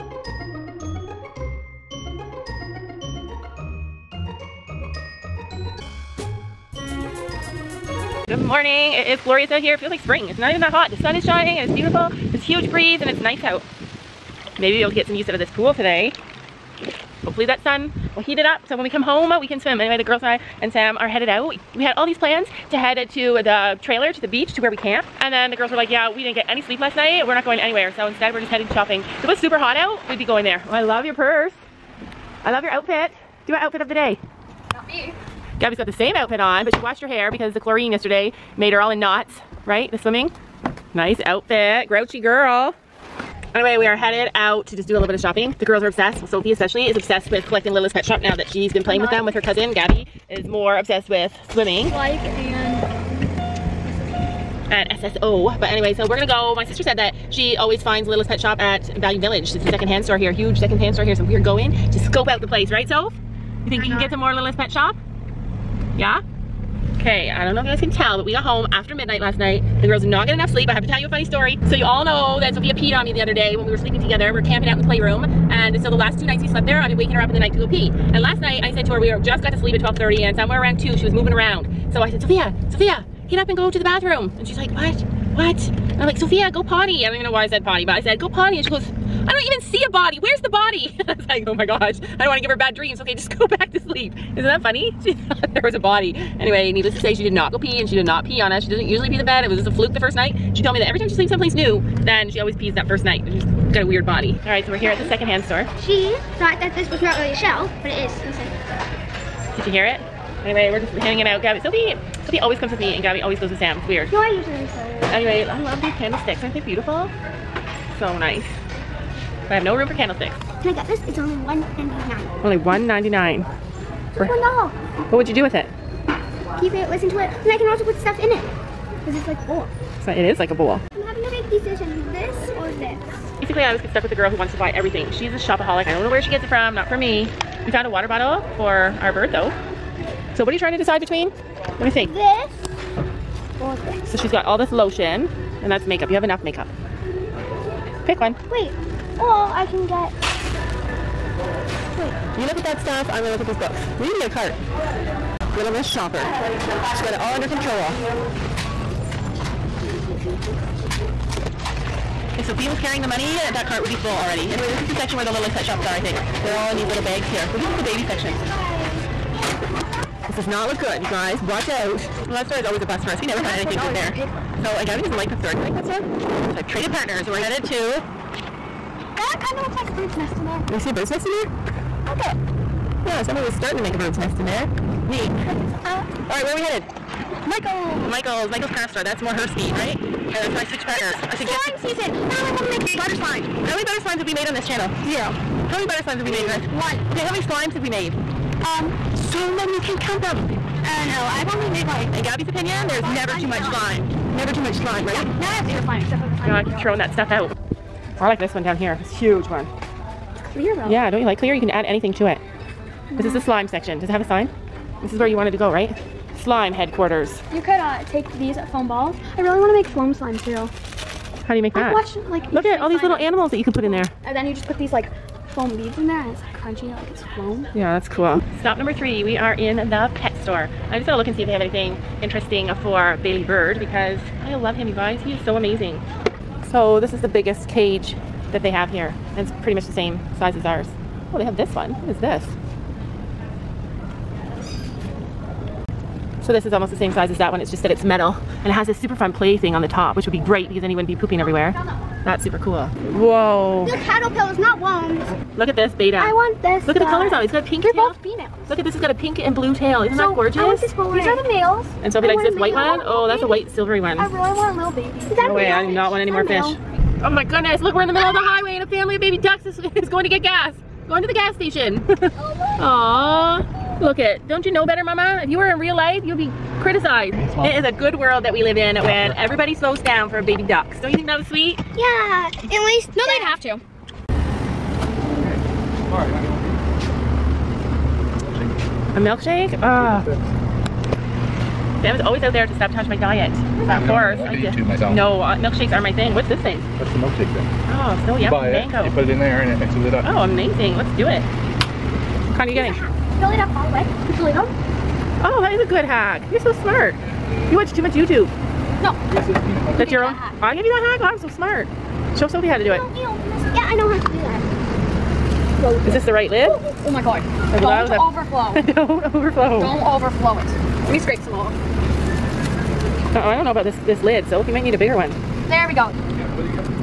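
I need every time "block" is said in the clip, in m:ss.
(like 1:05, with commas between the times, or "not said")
not said.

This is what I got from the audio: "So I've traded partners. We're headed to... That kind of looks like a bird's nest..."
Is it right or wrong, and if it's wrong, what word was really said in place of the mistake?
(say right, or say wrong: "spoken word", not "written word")
right.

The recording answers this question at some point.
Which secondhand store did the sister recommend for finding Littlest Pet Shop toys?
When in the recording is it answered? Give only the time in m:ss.
0:58.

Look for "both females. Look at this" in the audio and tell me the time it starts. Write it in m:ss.
4:18.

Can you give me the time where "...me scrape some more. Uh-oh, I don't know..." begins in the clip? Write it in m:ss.
5:21.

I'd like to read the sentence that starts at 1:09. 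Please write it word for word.
The girls not get enough sleep.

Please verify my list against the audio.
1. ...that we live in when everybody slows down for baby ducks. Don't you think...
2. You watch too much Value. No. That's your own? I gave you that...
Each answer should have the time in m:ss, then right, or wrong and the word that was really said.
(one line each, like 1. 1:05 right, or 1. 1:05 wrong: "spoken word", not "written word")
1. 4:38 right
2. 5:07 wrong: "YouTube", not "Value".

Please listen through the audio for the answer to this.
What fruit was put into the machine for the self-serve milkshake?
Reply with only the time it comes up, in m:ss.
4:58.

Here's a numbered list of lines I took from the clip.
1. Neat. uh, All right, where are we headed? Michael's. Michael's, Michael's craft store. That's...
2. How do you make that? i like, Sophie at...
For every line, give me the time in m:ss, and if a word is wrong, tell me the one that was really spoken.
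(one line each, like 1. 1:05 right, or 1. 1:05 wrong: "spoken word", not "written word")
1. 3:05 right
2. 3:41 wrong: "Look", not "Sophie".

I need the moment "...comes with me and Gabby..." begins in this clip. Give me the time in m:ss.
1:52.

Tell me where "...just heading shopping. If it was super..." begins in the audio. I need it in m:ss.
0:28.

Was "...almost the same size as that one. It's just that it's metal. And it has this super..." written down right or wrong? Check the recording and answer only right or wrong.
right.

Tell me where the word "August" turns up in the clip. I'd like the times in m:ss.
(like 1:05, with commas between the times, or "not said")
not said.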